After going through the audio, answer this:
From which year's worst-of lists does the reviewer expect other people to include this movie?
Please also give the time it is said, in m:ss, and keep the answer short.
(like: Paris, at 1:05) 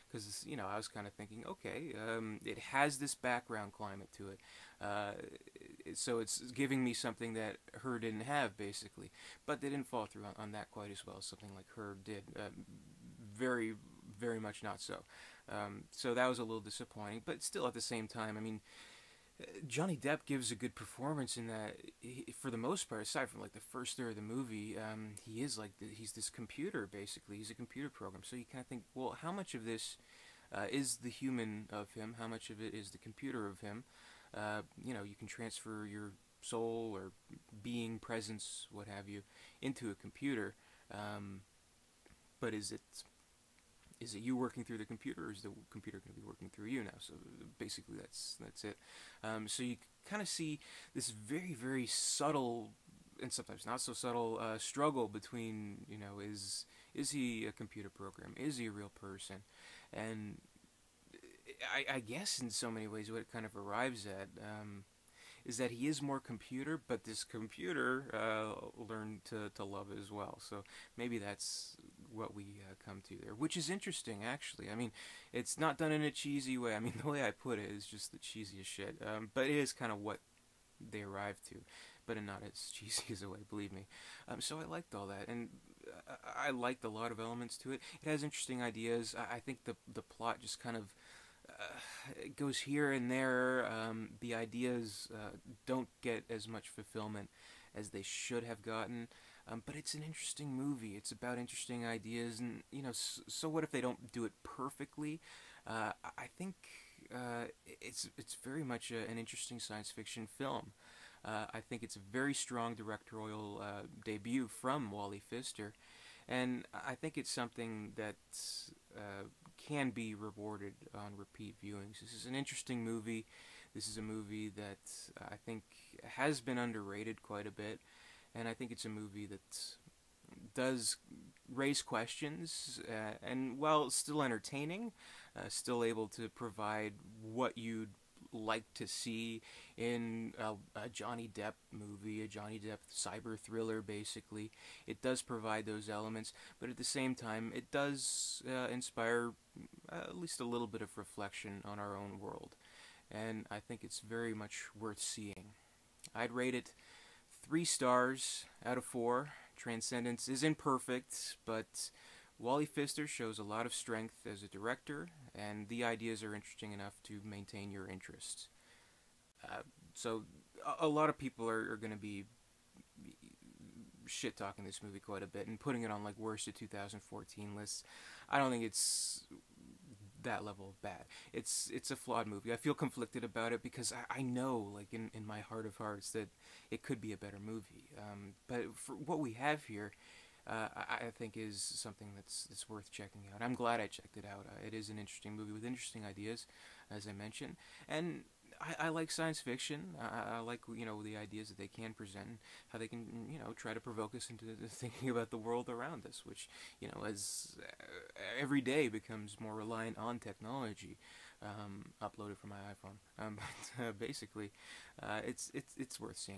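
2014, at 2:56.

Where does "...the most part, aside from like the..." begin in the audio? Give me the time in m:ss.
0:22.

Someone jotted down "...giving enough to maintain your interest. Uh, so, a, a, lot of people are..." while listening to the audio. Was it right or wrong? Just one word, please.
wrong.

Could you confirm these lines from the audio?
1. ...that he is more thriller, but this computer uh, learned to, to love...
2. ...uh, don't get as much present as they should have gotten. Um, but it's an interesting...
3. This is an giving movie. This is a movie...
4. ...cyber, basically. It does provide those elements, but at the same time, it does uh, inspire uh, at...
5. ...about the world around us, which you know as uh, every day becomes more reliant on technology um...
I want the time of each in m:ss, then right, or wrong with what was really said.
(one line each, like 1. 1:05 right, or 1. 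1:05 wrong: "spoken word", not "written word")
1. 1:05 wrong: "computer", not "thriller"
2. 1:35 wrong: "fulfillment", not "present"
3. 2:02 wrong: "interesting", not "giving"
4. 2:23 wrong: "thriller", not "cyber"
5. 3:25 right.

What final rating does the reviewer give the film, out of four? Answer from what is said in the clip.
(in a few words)
3 stars.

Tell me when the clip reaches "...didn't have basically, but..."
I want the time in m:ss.
0:08.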